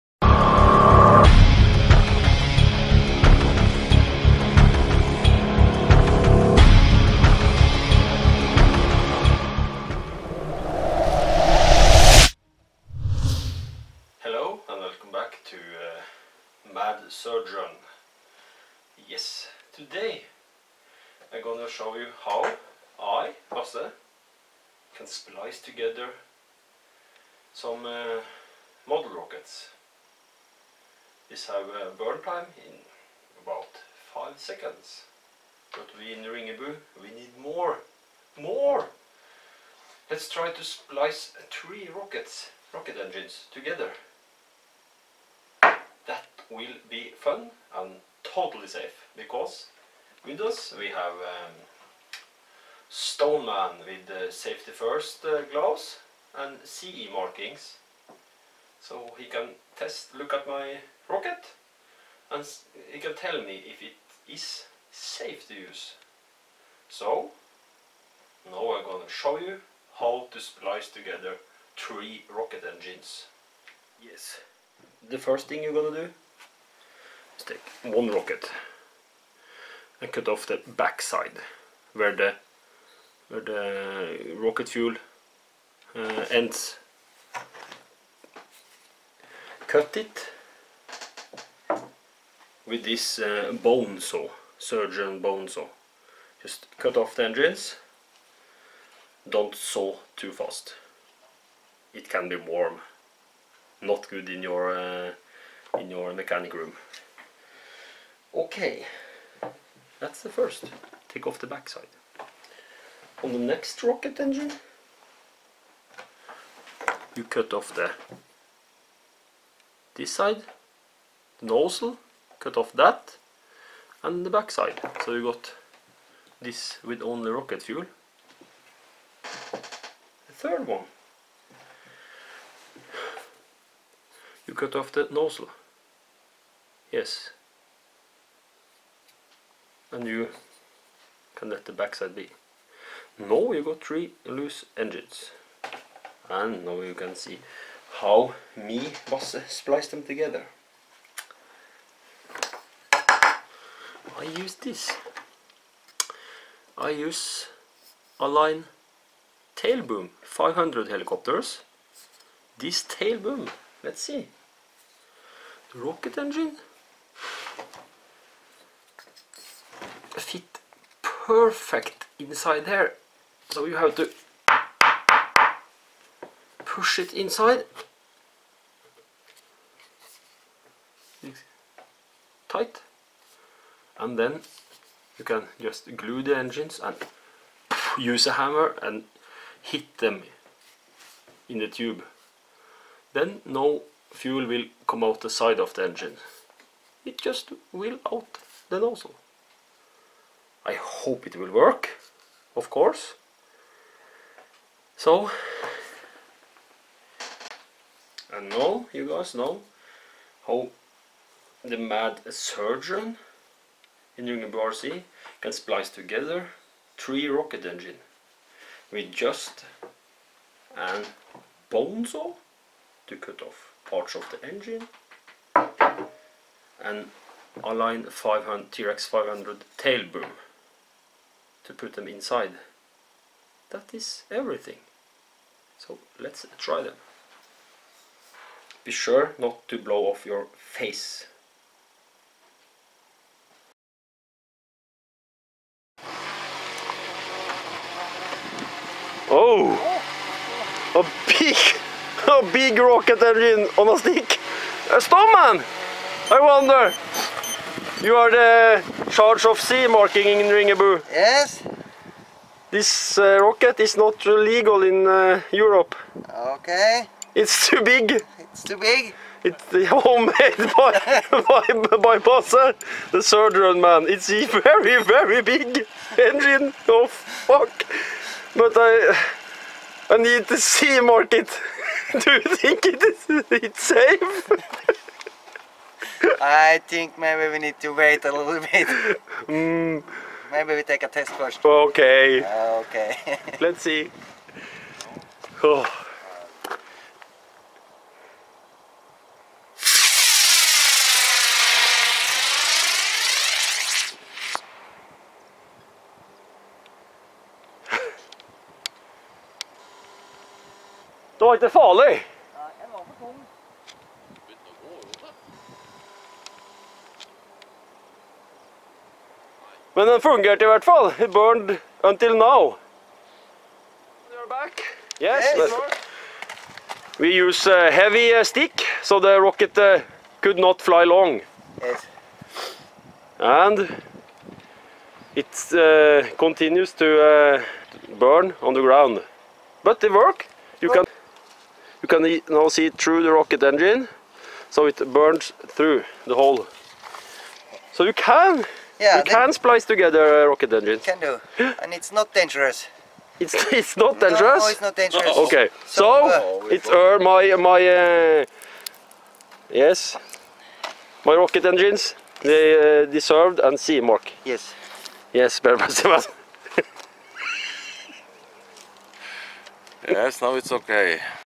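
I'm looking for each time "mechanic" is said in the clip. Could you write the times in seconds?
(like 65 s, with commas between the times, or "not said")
106 s.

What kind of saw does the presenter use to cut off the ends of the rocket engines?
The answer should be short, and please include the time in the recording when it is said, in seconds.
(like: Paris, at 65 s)
Surgeon bone saw, at 94 s.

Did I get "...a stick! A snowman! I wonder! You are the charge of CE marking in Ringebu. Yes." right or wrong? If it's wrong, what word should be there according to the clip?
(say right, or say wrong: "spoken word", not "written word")
right.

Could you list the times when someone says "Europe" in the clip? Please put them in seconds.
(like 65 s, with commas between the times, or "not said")
265 s.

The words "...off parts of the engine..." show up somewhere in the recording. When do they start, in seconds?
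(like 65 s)
223 s.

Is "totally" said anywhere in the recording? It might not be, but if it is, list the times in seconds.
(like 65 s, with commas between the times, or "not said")
48 s.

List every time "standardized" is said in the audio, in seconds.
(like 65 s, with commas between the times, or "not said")
not said.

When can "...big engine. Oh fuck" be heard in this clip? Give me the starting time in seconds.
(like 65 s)
275 s.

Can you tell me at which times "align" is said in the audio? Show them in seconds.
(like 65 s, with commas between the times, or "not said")
158 s, 227 s.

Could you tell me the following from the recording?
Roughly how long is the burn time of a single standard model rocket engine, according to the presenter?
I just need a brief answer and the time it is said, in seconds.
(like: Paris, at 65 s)
5 seconds, at 34 s.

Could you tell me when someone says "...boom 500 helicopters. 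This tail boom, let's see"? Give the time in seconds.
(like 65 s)
159 s.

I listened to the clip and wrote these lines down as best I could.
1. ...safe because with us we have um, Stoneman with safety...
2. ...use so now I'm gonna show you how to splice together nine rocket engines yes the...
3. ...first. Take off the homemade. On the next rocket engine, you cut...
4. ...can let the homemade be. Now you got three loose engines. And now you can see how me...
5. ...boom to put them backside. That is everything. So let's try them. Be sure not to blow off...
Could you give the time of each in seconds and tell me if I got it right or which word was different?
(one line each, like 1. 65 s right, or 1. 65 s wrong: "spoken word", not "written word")
1. 48 s right
2. 65 s wrong: "three", not "nine"
3. 110 s wrong: "backside", not "homemade"
4. 141 s wrong: "backside", not "homemade"
5. 230 s wrong: "inside", not "backside".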